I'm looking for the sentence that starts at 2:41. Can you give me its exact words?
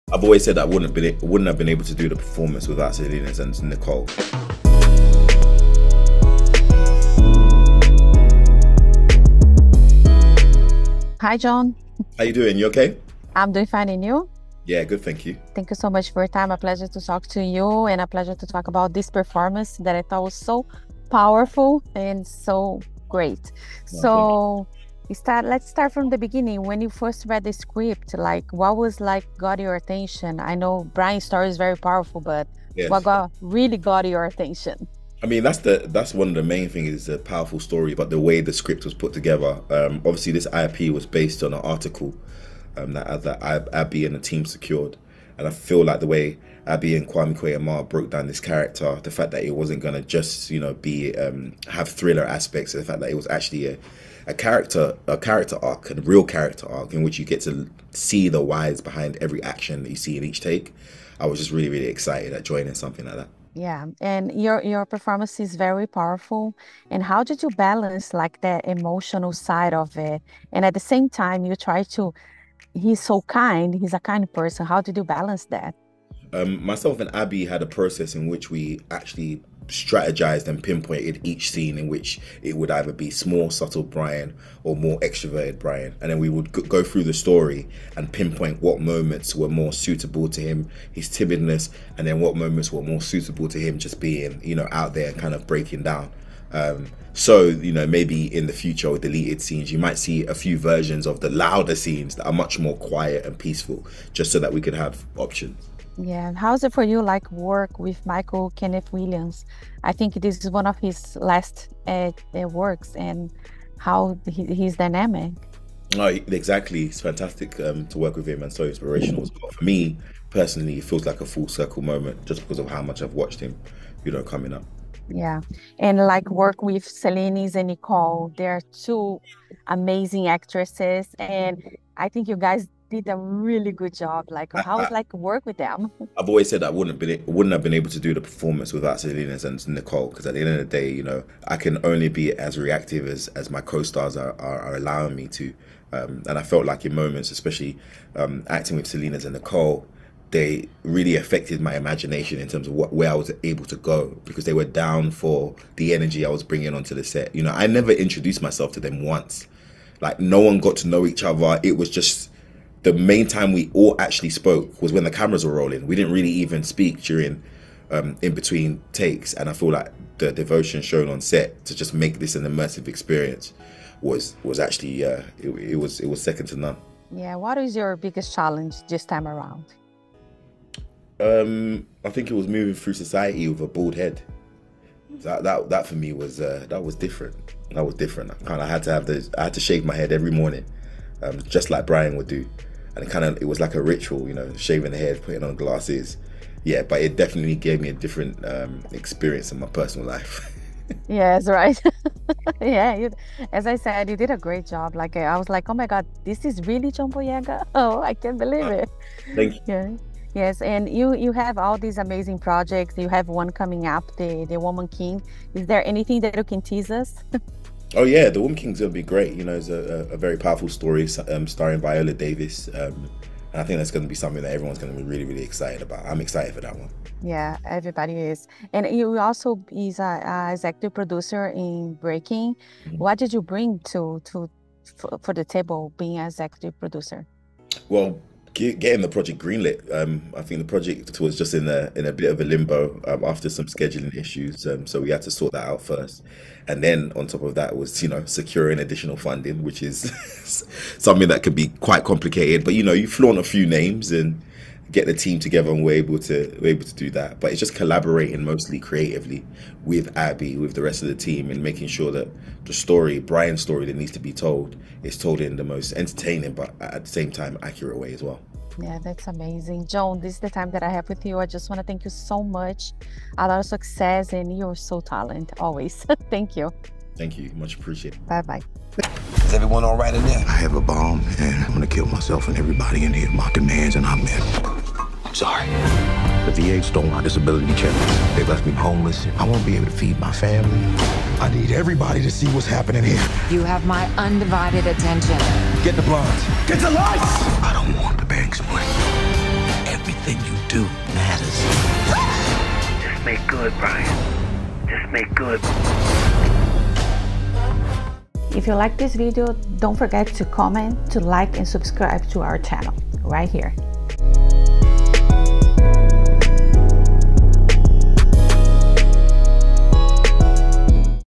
It was just the main time we all actually spoke was when the cameras were rolling.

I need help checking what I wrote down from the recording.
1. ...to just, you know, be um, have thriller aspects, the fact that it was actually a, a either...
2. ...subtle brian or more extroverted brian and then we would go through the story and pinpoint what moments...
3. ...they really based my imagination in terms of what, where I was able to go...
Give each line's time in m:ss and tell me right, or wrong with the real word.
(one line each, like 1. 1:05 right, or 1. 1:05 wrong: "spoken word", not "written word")
1. 0:49 wrong: "character", not "either"
2. 1:23 right
3. 2:30 wrong: "affected", not "based".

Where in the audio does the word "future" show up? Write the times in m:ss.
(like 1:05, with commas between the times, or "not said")
1:38.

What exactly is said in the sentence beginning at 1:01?
I was just really, really excited at joining something like that.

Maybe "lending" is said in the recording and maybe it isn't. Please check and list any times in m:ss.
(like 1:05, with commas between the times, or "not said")
not said.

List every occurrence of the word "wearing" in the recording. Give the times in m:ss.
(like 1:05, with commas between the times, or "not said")
not said.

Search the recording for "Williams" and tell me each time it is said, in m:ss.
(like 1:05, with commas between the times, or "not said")
1:48.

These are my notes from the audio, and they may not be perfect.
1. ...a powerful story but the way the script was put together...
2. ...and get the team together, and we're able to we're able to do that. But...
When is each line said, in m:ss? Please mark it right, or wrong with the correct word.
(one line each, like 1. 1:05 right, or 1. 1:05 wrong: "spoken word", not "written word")
1. 0:37 right
2. 4:14 right.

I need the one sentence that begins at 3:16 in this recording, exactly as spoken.
Yeah, but it definitely gave me a different um, experience in my personal life.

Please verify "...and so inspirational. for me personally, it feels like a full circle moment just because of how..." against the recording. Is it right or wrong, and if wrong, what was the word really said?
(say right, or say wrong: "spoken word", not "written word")
right.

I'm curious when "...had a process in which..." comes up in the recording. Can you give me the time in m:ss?
1:17.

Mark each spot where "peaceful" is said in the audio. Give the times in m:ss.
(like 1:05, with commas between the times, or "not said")
1:43.